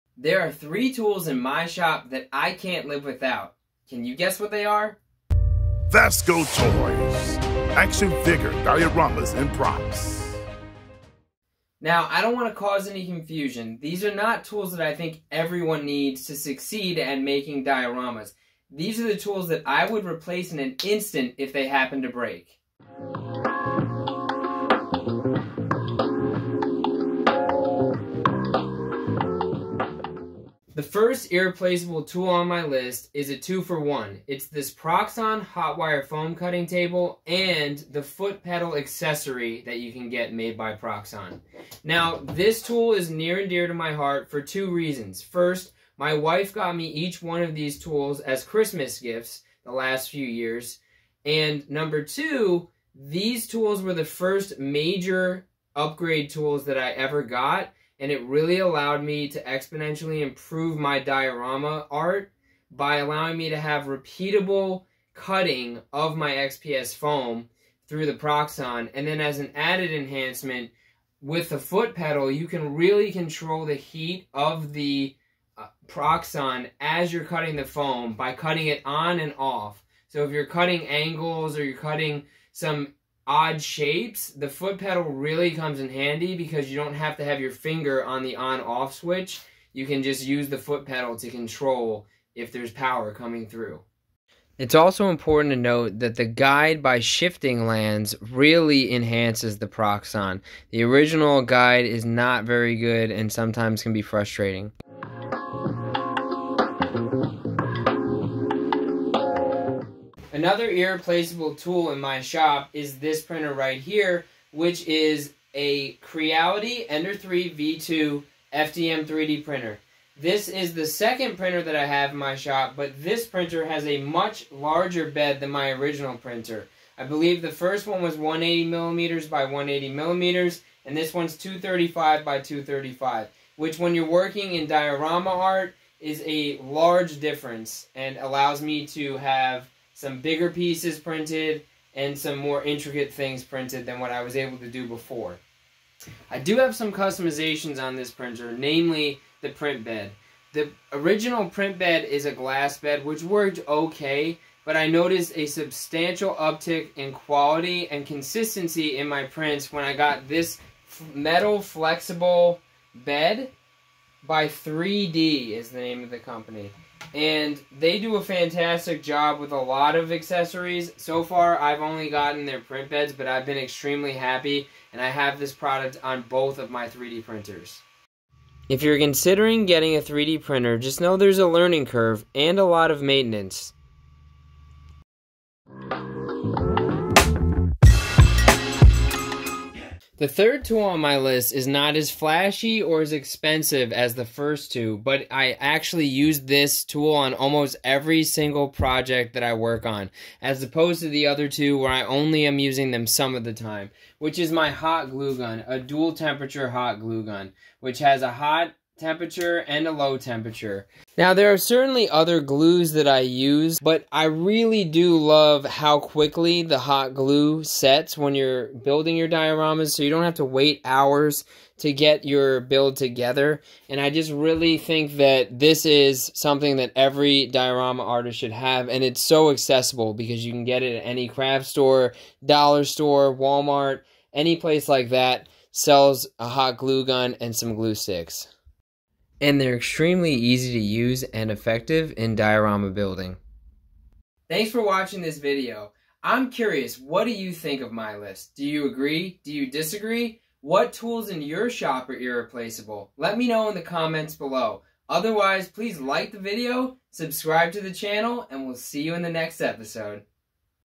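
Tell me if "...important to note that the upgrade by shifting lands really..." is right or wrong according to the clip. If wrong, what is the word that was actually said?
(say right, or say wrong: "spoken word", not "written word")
wrong: "guide", not "upgrade".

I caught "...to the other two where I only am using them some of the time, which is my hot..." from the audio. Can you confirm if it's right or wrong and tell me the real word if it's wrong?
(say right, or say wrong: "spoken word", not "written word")
right.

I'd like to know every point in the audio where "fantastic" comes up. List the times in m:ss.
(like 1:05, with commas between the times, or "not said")
2:48.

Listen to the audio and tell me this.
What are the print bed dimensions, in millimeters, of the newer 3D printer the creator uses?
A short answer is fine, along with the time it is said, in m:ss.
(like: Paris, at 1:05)
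235 by 235, at 2:11.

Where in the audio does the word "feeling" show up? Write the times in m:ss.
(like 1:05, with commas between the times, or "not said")
not said.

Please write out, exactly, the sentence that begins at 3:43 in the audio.
And I just really think that this is something that every diorama artist should have.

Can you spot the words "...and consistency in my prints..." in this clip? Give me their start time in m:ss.
2:37.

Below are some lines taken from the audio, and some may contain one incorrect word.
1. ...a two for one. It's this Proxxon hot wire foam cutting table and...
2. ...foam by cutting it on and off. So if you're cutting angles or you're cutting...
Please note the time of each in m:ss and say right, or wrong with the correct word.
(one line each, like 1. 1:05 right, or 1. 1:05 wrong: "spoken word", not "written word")
1. 0:33 right
2. 1:17 right.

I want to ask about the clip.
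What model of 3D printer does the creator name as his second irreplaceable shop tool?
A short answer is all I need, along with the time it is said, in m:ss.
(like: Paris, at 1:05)
Creality Ender 3 V2, at 1:56.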